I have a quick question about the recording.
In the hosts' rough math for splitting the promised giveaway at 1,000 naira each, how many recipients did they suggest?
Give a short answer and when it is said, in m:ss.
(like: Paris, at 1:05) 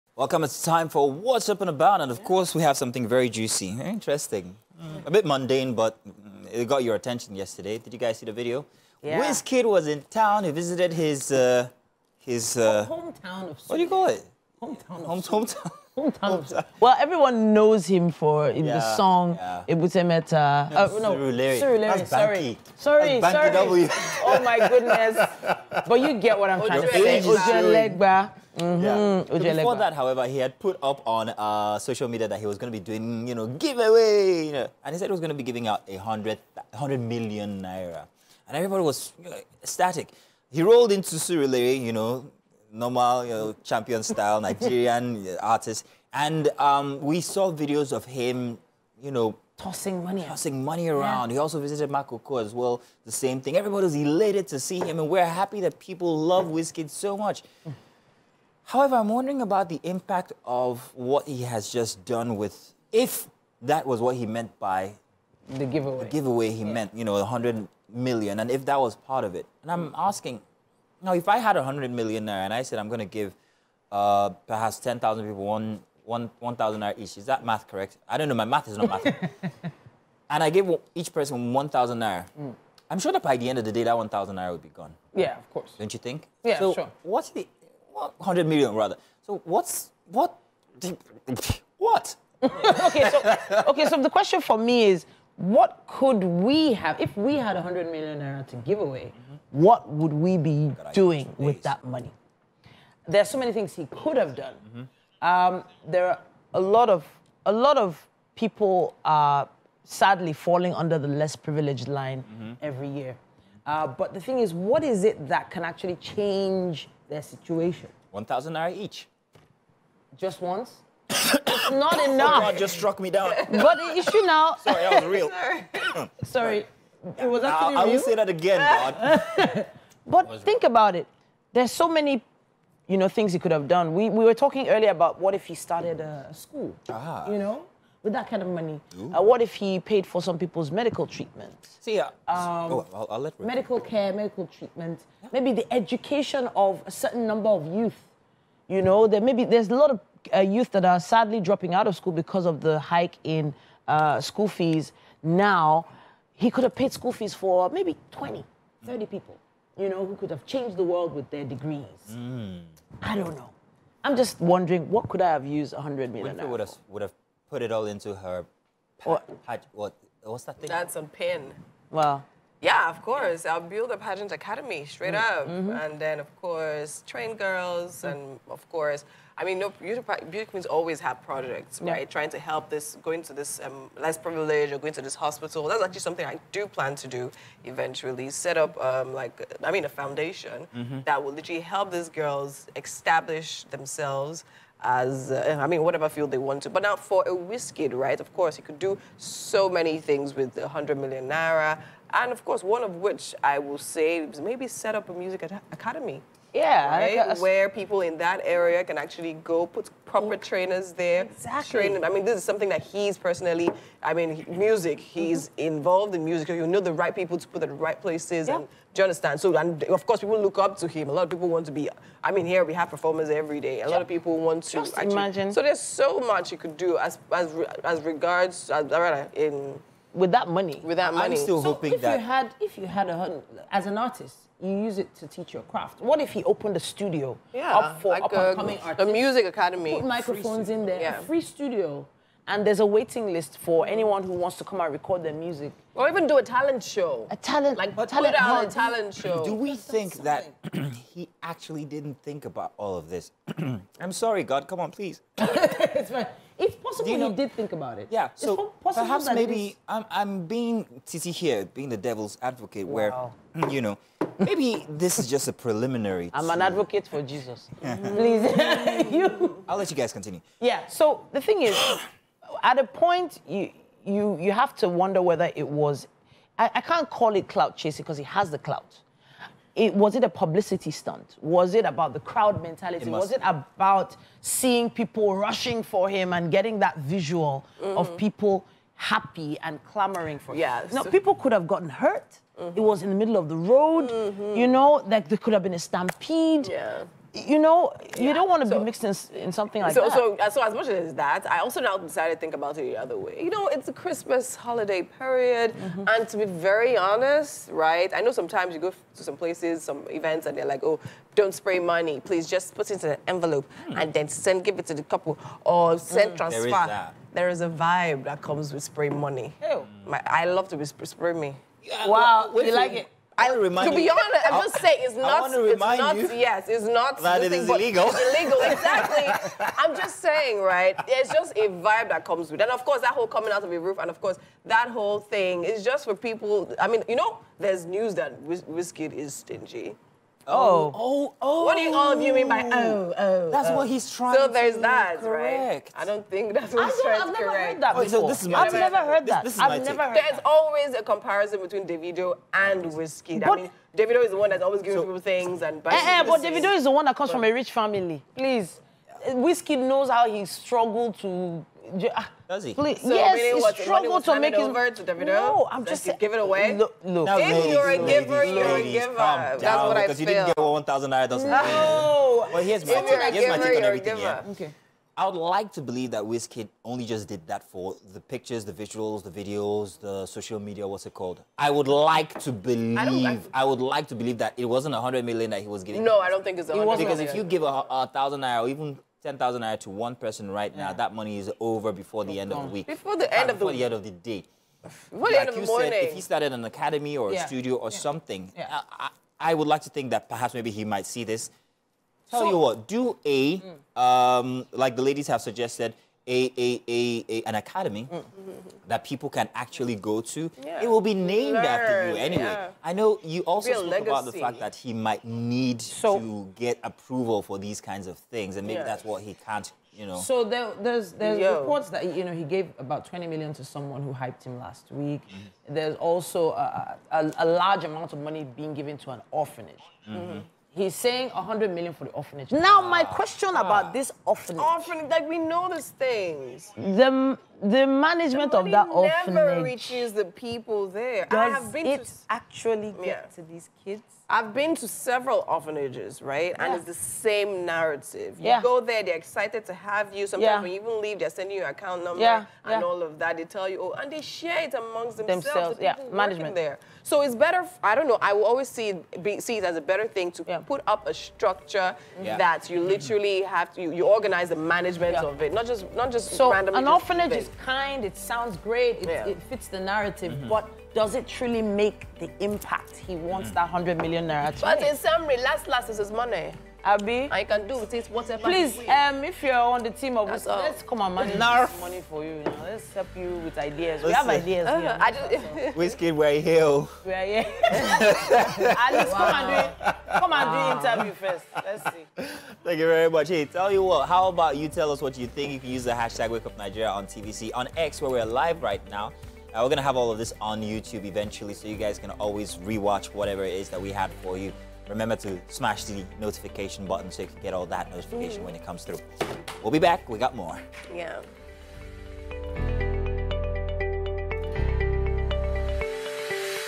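10,000 people, at 1:14.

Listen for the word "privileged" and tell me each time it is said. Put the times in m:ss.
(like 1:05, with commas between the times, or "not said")
1:51, 3:04.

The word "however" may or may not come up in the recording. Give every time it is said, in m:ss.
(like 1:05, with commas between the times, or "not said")
0:29, 0:58.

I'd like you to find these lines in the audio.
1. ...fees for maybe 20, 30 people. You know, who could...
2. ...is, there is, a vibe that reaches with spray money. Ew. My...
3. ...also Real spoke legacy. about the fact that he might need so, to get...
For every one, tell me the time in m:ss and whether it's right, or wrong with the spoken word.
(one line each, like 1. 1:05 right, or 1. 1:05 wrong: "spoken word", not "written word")
1. 2:37 right
2. 5:16 wrong: "comes", not "reaches"
3. 6:53 right.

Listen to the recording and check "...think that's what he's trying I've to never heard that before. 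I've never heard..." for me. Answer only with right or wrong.
right.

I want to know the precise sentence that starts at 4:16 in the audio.
It's possible you know, he did think about it.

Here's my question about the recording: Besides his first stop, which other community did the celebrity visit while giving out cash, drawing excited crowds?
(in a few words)
Makoko.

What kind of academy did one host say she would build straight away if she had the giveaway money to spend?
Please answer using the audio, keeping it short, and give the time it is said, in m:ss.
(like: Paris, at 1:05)
pageant academy, at 2:53.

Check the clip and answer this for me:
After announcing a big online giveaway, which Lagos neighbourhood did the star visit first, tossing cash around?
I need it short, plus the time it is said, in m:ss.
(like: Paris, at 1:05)
Surulere, at 0:41.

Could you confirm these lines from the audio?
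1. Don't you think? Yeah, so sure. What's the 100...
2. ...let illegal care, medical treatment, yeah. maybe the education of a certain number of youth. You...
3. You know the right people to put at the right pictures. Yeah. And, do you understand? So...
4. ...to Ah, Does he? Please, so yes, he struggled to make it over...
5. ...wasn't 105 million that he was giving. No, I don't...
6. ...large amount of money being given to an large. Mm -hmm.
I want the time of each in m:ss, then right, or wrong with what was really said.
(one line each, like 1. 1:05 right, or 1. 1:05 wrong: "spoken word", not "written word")
1. 1:25 right
2. 2:23 wrong: "medical", not "illegal"
3. 3:36 wrong: "places", not "pictures"
4. 6:01 right
5. 6:24 wrong: "100", not "105"
6. 7:07 wrong: "orphanage", not "large".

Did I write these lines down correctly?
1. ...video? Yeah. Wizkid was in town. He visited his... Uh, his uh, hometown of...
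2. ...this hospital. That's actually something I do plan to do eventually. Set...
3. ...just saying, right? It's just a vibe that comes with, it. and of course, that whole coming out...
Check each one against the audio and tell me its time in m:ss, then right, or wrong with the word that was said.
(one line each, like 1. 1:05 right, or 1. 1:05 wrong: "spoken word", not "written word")
1. 0:08 right
2. 3:05 right
3. 5:29 right.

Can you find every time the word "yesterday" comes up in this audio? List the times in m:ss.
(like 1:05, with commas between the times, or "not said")
0:07.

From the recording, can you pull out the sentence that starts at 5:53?
But, I mean, Davido is the one that's always giving so, people things and...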